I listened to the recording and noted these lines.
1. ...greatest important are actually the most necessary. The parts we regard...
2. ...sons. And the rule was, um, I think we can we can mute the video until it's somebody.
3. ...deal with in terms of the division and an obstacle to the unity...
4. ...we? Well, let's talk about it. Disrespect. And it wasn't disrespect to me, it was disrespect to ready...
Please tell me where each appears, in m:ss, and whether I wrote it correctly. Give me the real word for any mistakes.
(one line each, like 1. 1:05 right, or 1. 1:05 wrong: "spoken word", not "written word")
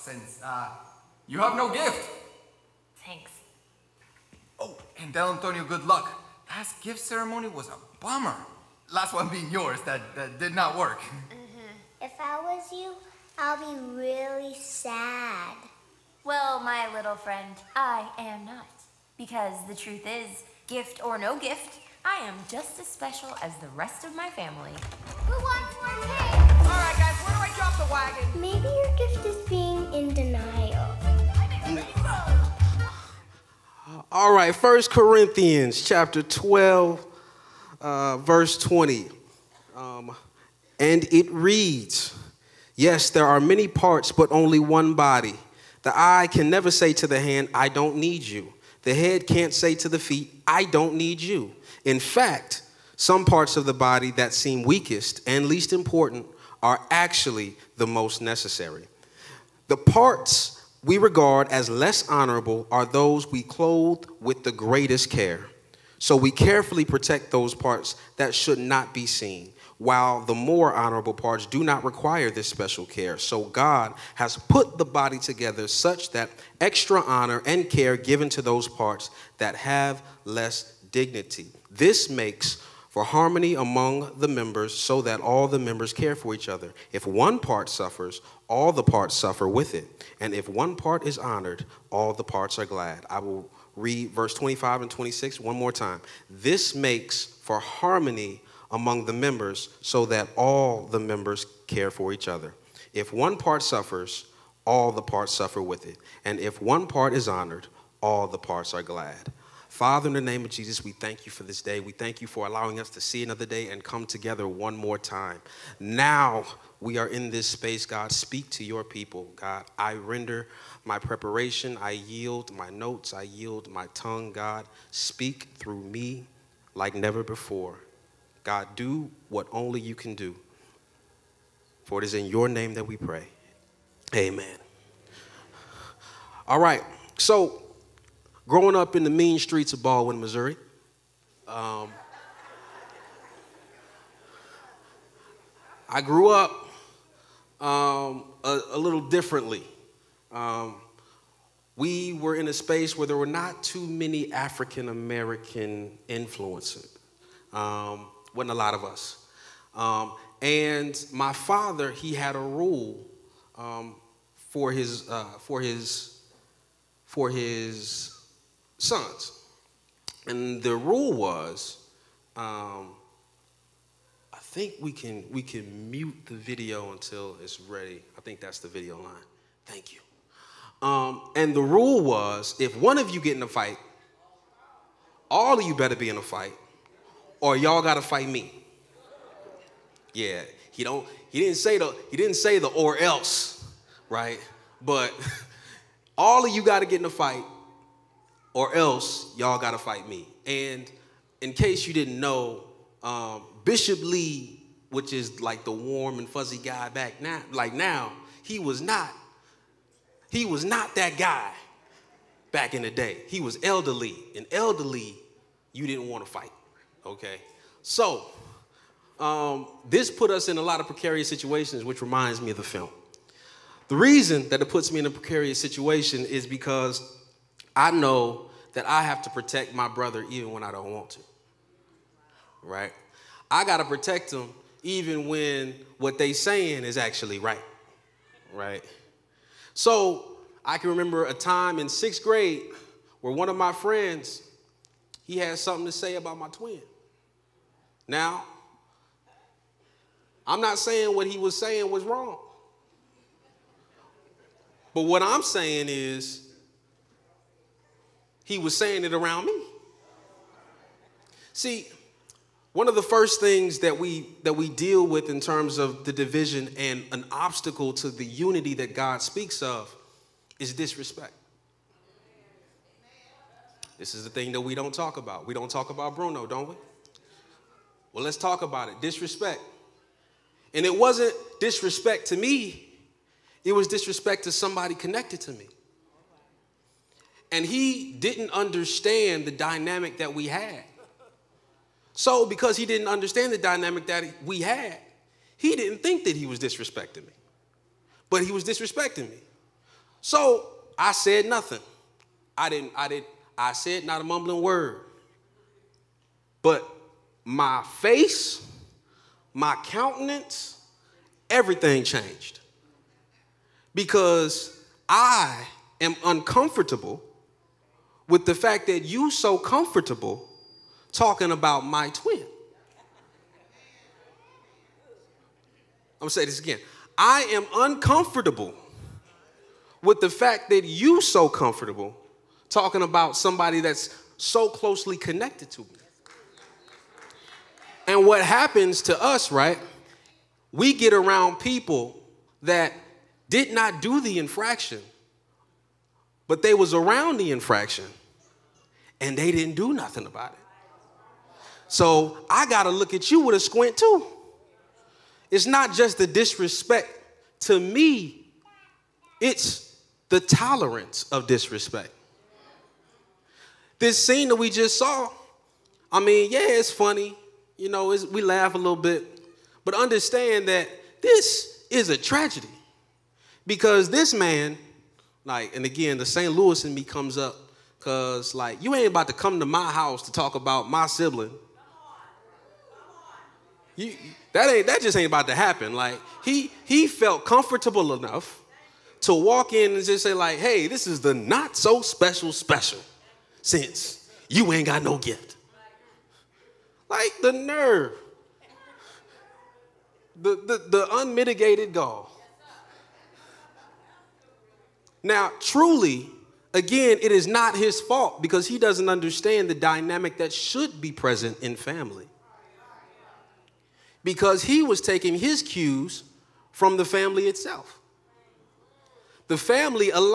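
1. 0:55 wrong: "least", not "greatest"
2. 2:48 wrong: "ready", not "somebody"
3. 4:24 right
4. 4:36 wrong: "somebody", not "ready".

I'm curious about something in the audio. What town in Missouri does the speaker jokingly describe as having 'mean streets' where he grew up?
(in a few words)
Ballwin.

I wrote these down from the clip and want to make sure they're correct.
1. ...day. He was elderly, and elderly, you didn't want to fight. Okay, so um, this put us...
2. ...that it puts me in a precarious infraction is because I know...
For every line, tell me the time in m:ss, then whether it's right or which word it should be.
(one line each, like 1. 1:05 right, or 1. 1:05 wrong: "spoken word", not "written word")
1. 3:32 right
2. 3:44 wrong: "situation", not "infraction".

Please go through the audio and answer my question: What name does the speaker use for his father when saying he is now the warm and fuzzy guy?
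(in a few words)
Bishop Lee.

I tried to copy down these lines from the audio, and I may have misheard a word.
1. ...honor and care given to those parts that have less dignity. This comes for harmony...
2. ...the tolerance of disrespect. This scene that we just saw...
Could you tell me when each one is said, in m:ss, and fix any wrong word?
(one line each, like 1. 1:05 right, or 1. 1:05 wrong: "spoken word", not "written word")
1. 1:17 wrong: "makes", not "comes"
2. 6:00 right.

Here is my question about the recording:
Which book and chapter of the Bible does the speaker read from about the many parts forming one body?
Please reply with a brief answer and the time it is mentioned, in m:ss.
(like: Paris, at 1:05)
First Corinthians 12, at 0:34.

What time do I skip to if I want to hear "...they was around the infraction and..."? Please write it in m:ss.
5:46.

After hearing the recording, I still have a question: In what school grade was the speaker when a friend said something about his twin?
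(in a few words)
6th grade.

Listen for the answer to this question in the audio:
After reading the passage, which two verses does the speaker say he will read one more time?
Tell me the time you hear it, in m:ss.
1:34.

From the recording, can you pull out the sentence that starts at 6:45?
Now, truly, again, it is not his fault because he doesn't understand the dynamic that should be present in family.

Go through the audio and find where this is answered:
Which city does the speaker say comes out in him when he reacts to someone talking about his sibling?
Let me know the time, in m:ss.
6:16.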